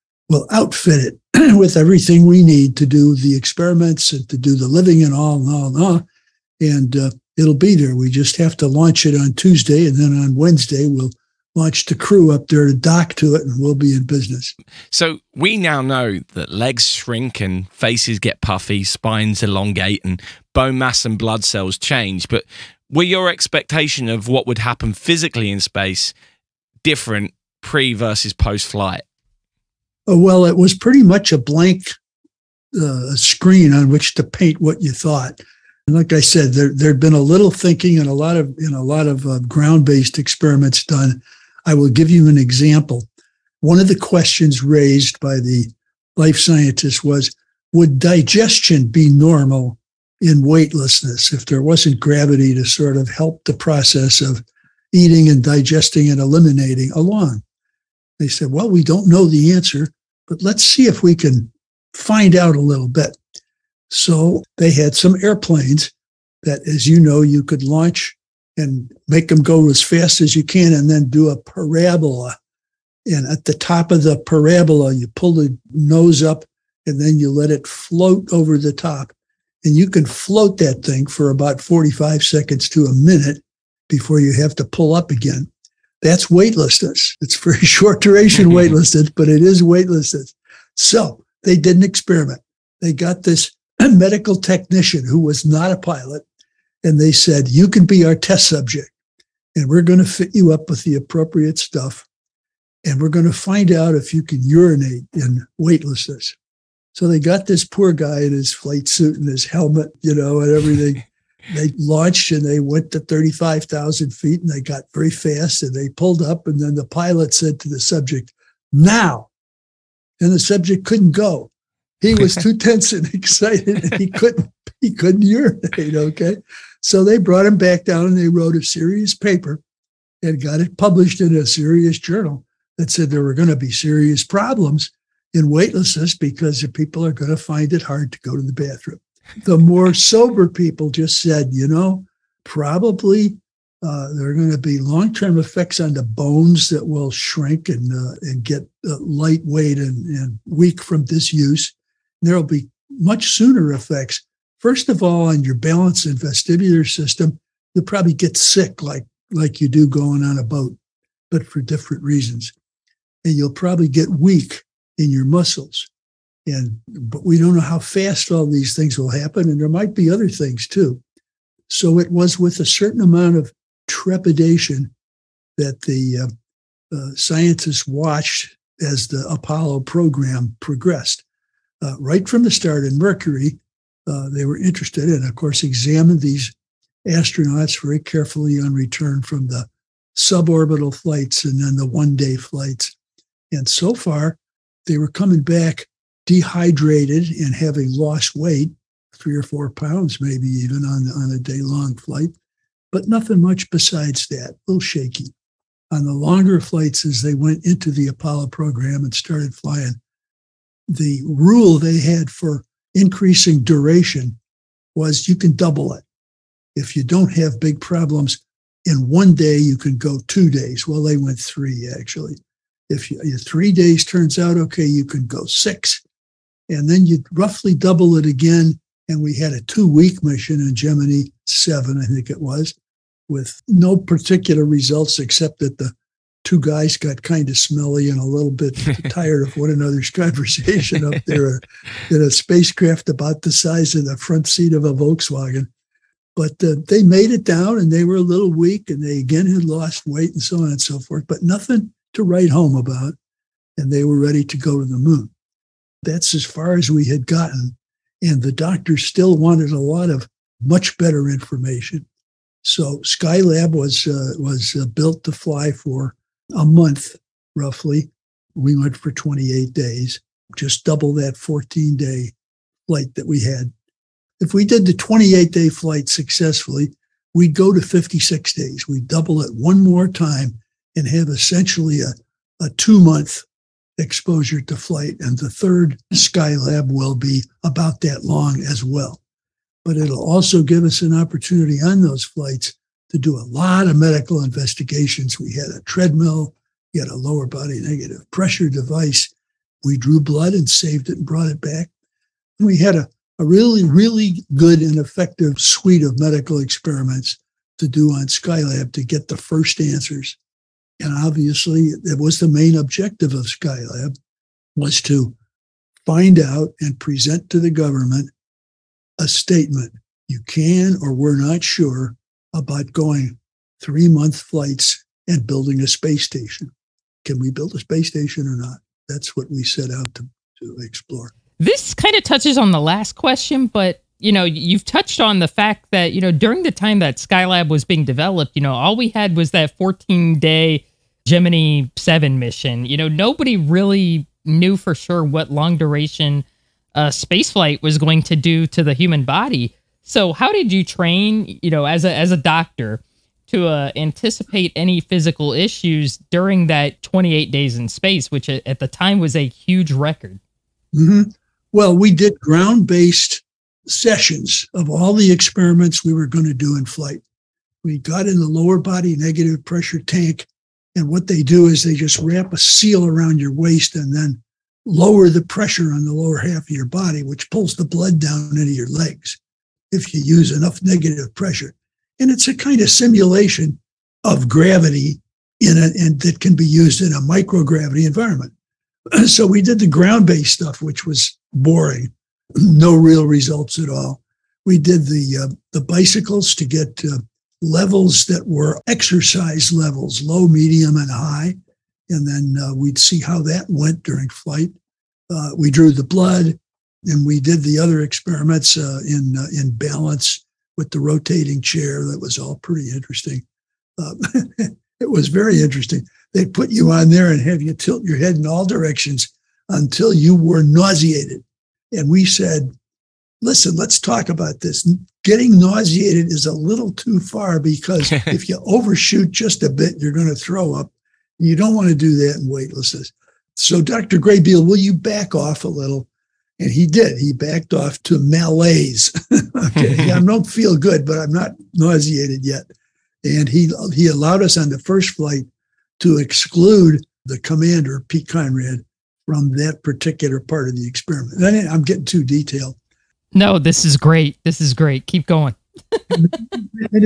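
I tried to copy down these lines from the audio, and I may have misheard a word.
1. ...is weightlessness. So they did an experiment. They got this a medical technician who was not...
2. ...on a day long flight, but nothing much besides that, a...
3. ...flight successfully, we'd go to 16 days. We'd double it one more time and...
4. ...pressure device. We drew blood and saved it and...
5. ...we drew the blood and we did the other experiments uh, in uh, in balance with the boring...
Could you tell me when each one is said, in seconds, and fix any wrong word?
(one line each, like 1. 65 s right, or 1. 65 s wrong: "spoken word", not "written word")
1. 89 s right
2. 201 s right
3. 275 s wrong: "56", not "16"
4. 298 s right
5. 405 s wrong: "rotating", not "boring".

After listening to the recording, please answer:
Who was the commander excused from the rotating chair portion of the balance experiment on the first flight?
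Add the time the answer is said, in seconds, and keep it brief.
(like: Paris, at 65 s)
Pete Conrad, at 448 s.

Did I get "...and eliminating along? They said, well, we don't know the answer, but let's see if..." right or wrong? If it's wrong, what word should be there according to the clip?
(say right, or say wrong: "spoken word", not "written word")
right.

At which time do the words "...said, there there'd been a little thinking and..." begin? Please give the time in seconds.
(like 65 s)
36 s.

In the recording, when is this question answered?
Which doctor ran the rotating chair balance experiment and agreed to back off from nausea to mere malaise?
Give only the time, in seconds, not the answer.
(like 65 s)
433 s.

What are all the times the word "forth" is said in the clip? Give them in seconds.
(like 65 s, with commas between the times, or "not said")
250 s.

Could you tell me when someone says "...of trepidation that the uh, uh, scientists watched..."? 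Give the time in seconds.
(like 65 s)
173 s.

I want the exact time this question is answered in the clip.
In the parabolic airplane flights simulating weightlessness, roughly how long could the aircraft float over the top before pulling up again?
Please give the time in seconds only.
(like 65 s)
81 s.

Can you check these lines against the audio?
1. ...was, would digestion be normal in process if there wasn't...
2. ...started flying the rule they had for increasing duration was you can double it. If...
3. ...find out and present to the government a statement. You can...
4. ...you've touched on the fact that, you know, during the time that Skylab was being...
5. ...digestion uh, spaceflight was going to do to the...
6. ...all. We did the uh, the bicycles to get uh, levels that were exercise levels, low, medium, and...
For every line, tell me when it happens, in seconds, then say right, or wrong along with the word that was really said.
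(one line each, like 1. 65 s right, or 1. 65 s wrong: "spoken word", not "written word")
1. 47 s wrong: "weightlessness", not "process"
2. 209 s right
3. 316 s right
4. 334 s right
5. 345 s wrong: "duration", not "digestion"
6. 393 s right.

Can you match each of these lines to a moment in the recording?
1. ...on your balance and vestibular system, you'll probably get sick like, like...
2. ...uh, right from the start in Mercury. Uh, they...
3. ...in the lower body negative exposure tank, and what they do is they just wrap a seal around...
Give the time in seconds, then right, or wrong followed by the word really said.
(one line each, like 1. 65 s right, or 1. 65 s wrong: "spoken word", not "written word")
1. 155 s right
2. 181 s right
3. 368 s wrong: "pressure", not "exposure".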